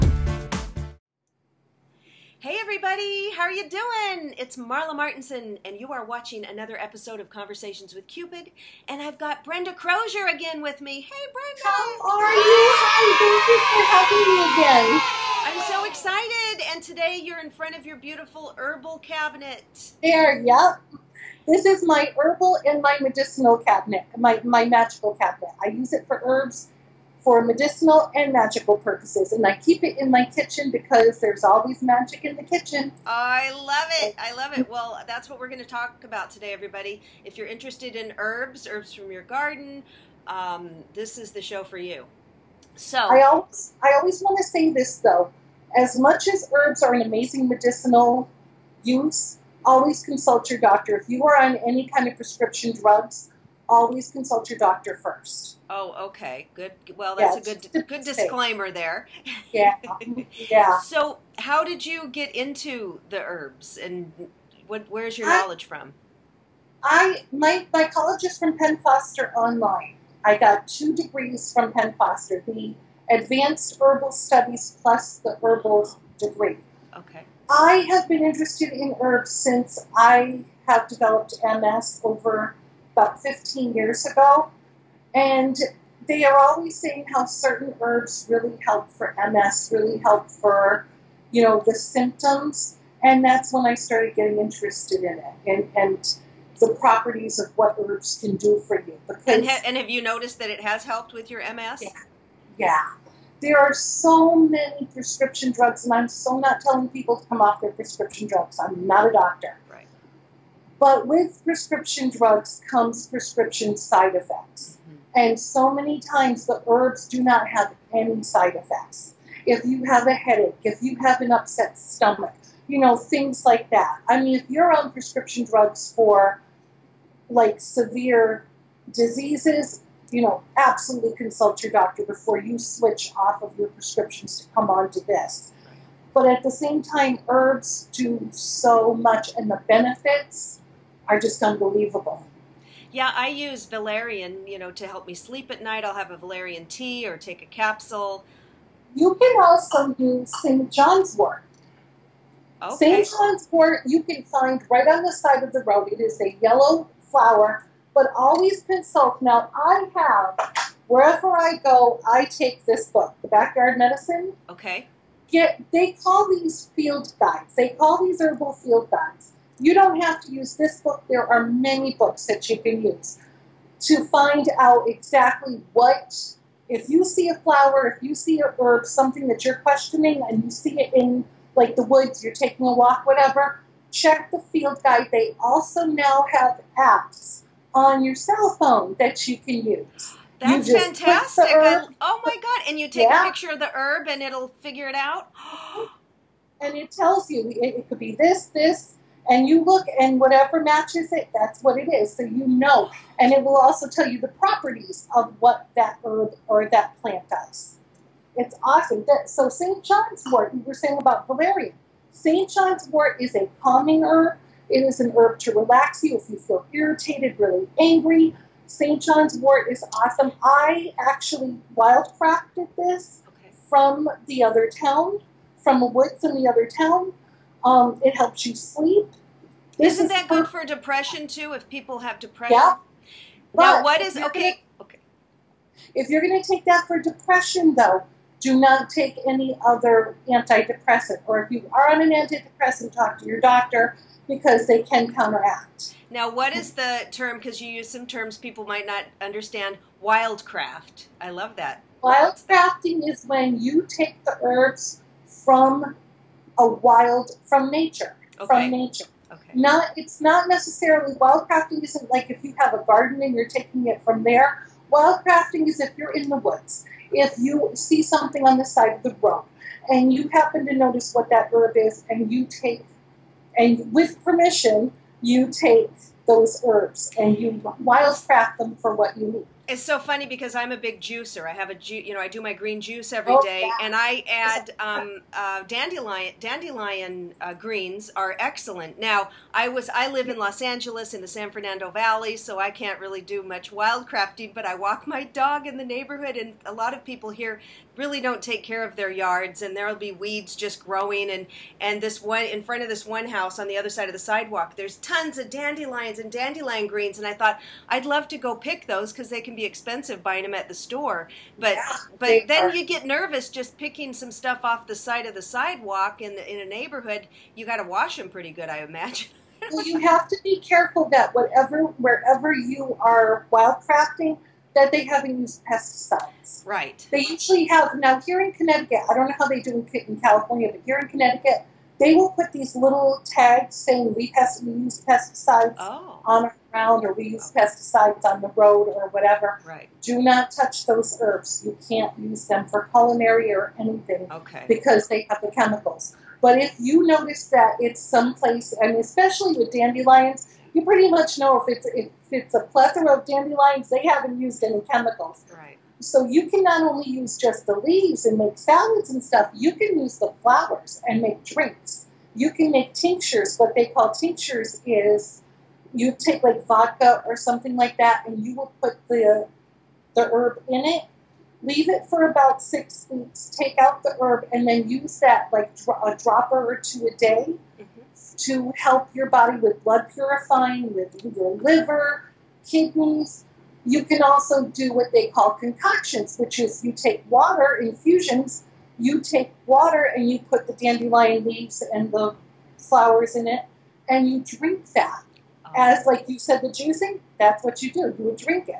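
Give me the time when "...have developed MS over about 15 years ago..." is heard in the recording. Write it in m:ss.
1:20.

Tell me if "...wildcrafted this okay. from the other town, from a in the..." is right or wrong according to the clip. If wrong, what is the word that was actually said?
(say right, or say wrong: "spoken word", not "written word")
right.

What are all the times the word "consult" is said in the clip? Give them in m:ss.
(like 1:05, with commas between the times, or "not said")
0:50, 0:54, 2:11, 2:38.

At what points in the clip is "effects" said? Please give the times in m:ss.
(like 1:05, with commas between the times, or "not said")
1:54, 1:58.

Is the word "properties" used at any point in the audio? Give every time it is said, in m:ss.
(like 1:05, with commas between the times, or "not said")
1:36, 3:24.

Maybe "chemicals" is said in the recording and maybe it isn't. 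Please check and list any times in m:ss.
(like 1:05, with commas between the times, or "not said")
5:45, 5:54.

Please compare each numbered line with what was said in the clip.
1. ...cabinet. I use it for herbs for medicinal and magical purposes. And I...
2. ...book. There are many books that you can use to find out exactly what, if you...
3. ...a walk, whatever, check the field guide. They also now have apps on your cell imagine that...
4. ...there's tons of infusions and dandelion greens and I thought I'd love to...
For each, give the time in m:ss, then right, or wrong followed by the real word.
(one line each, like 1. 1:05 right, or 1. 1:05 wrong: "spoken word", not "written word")
1. 0:25 right
2. 2:50 right
3. 3:02 wrong: "phone", not "imagine"
4. 5:04 wrong: "dandelions", not "infusions".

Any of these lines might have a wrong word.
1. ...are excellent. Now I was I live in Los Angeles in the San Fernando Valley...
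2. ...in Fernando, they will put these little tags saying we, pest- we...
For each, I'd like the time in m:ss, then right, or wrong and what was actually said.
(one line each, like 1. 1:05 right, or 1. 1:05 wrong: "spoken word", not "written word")
1. 4:48 right
2. 5:30 wrong: "Connecticut", not "Fernando".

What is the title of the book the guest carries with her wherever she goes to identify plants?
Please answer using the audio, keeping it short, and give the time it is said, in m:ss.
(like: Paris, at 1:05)
The Backyard Medicine, at 2:43.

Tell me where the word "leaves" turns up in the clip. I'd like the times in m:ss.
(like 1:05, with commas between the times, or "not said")
5:57, 6:11, 6:31.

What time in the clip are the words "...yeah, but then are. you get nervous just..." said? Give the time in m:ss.
5:11.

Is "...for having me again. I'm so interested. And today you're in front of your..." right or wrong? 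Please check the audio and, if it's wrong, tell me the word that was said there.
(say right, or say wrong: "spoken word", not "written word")
wrong: "excited", not "interested".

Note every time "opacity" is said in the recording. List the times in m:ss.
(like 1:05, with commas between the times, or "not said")
not said.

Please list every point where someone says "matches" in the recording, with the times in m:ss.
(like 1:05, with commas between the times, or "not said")
3:20.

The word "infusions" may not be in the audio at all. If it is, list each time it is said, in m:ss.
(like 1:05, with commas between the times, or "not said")
6:27.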